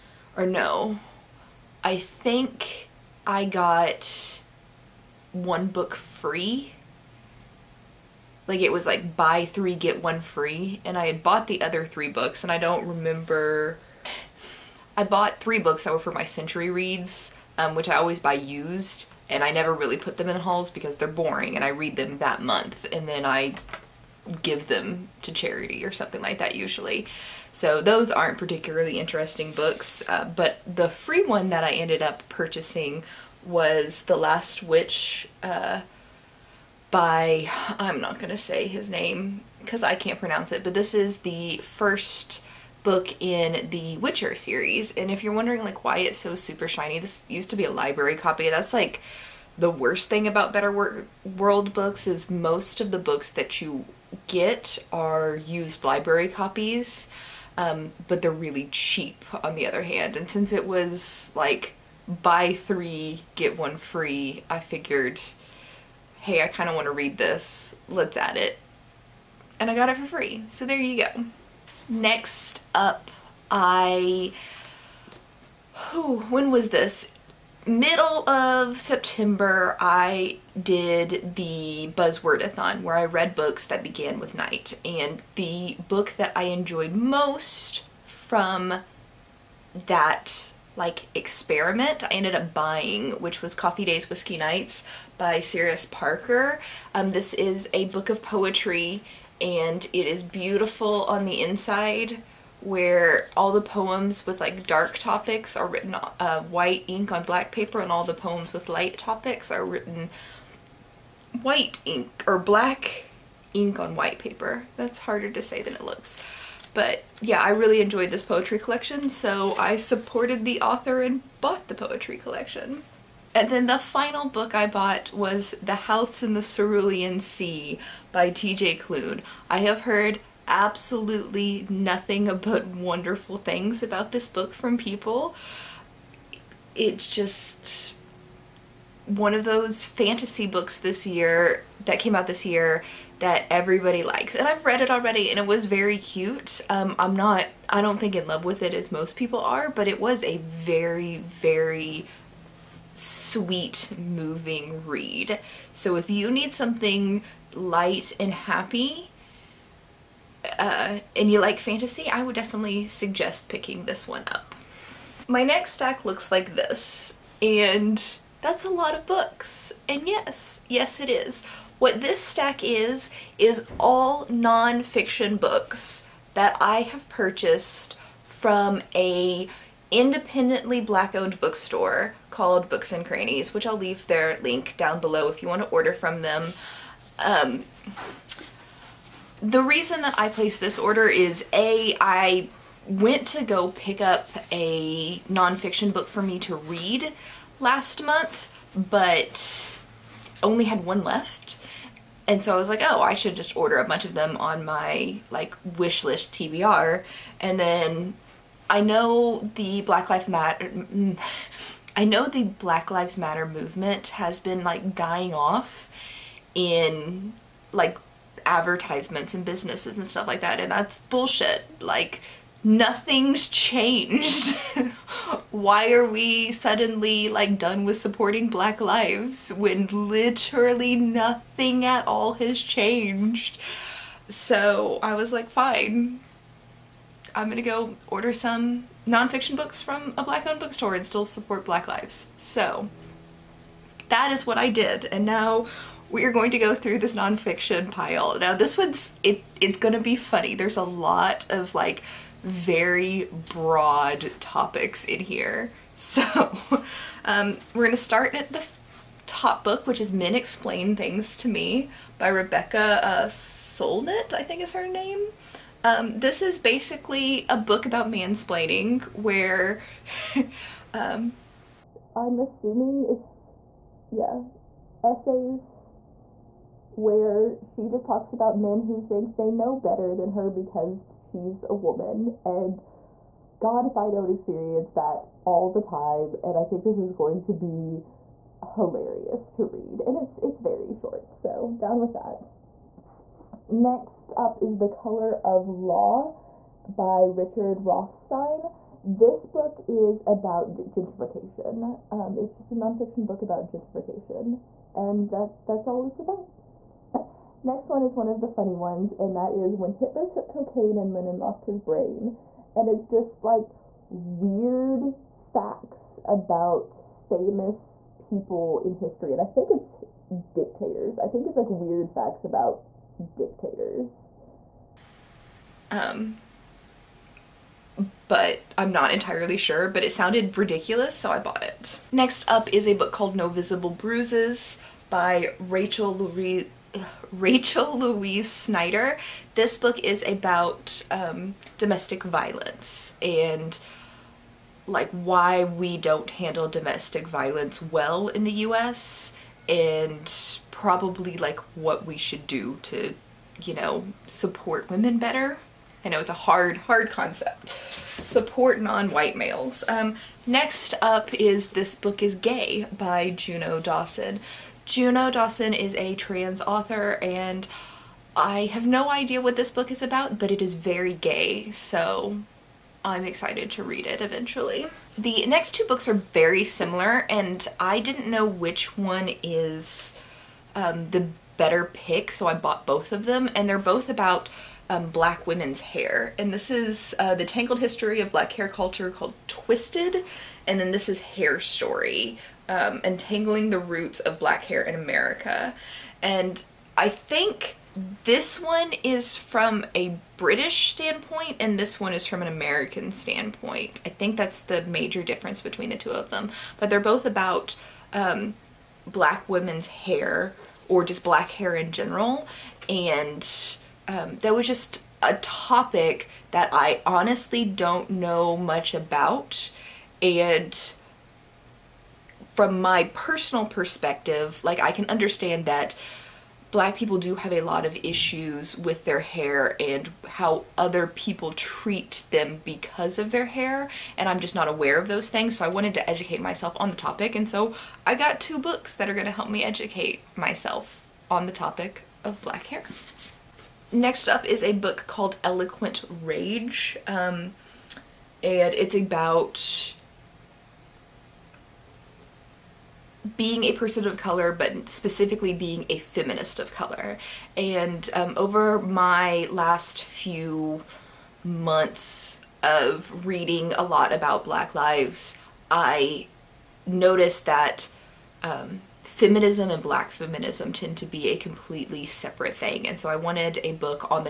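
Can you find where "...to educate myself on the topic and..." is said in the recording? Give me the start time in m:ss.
7:15.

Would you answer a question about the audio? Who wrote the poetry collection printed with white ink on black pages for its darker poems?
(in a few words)
Cyrus Parker.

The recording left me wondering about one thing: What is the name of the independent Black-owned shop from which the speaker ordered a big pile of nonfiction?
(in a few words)
Books and Crannies.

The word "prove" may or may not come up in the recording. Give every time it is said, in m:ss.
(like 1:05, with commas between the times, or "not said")
not said.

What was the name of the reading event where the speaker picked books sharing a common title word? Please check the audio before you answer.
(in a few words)
Buzzwordathon.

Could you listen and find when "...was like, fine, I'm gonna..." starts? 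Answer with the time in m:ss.
3:55.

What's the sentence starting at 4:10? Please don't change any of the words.
There's a lot of like very broad topics in here.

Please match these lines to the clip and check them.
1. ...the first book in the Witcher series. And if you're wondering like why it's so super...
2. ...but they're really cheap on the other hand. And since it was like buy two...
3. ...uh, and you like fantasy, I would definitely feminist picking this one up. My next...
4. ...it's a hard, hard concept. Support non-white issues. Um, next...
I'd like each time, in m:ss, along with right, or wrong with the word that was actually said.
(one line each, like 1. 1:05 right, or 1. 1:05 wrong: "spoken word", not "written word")
1. 0:41 right
2. 0:58 wrong: "three", not "two"
3. 2:40 wrong: "suggest", not "feminist"
4. 5:56 wrong: "males", not "issues".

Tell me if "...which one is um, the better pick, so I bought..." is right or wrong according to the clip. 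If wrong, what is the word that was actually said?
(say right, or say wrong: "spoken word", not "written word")
right.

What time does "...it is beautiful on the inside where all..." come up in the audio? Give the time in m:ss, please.
1:39.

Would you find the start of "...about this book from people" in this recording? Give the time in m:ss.
2:13.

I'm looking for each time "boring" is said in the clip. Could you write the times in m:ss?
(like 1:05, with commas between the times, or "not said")
0:21.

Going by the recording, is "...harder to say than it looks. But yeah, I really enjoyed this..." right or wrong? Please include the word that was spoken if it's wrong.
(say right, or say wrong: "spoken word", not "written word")
right.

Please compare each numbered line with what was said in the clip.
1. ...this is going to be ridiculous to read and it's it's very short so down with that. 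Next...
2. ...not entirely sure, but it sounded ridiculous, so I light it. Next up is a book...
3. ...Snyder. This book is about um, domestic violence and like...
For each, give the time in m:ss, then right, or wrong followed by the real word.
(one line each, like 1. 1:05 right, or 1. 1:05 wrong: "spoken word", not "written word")
1. 4:46 wrong: "hilarious", not "ridiculous"
2. 5:28 wrong: "bought", not "light"
3. 5:38 right.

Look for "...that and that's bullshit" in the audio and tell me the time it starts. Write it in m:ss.
3:40.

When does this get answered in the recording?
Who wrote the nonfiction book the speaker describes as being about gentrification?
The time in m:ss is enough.
4:57.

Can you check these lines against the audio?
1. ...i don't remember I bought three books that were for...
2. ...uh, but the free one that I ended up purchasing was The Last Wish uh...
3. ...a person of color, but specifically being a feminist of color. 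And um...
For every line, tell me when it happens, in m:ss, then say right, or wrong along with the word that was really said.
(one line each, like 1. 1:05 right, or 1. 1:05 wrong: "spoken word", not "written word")
1. 0:12 right
2. 0:30 right
3. 7:33 right.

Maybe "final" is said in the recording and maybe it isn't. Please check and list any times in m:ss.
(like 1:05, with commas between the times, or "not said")
2:03.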